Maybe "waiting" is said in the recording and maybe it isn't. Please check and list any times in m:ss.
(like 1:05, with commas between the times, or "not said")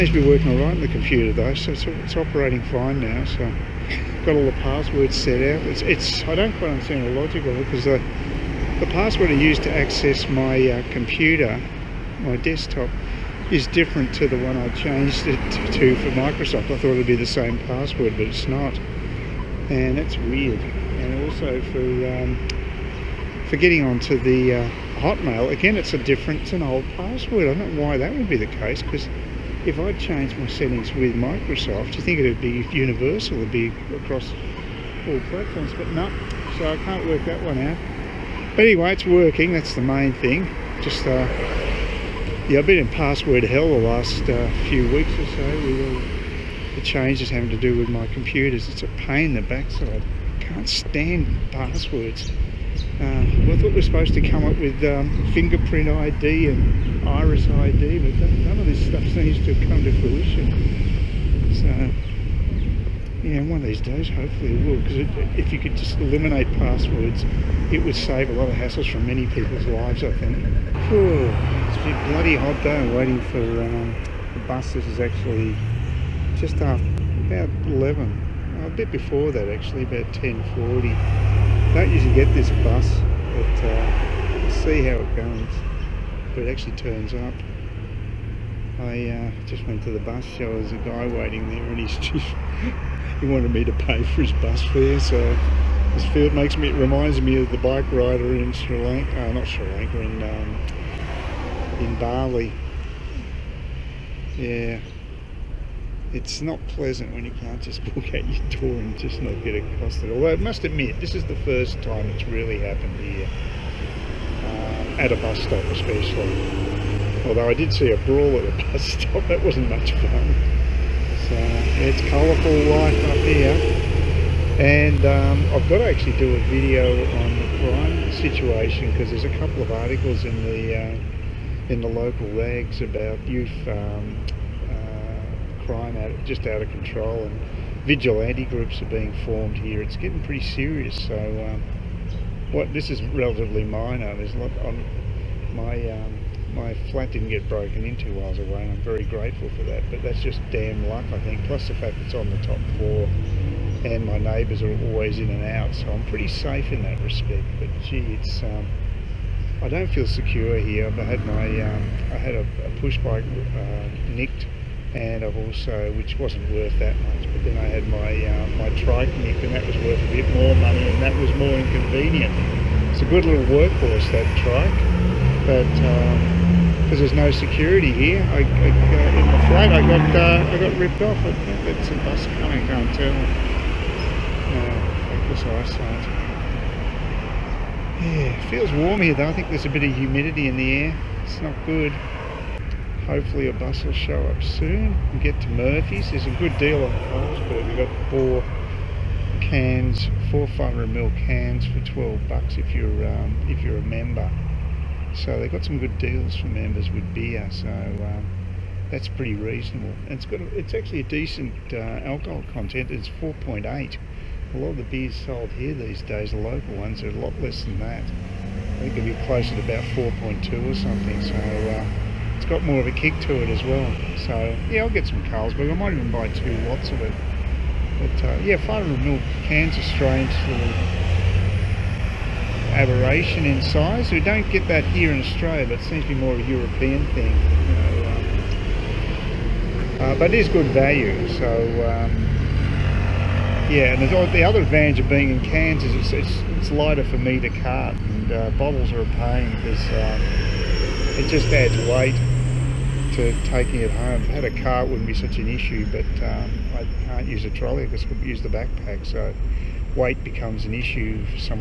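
1:12, 1:31.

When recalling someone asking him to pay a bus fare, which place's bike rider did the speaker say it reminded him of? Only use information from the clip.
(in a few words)
Bali.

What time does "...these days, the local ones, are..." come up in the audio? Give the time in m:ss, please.
3:35.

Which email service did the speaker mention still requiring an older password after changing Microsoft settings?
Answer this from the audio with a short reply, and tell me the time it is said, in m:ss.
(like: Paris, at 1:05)
Hotmail, at 0:24.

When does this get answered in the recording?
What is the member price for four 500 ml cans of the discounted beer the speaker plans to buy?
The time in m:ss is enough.
3:21.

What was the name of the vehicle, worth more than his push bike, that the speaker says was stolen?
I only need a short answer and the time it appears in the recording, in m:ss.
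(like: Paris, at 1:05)
Triton, at 2:48.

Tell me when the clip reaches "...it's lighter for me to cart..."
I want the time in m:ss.
4:06.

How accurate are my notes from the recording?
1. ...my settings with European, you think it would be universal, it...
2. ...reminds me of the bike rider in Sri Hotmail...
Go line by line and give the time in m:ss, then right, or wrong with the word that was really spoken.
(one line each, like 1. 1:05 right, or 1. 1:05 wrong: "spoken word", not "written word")
1. 0:30 wrong: "Microsoft", not "European"
2. 1:36 wrong: "Lanka", not "Hotmail".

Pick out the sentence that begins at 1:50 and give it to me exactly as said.
Although I must admit, this is the first time it's really happened here, uh, at a bus stop especially.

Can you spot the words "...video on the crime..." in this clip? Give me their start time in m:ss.
2:06.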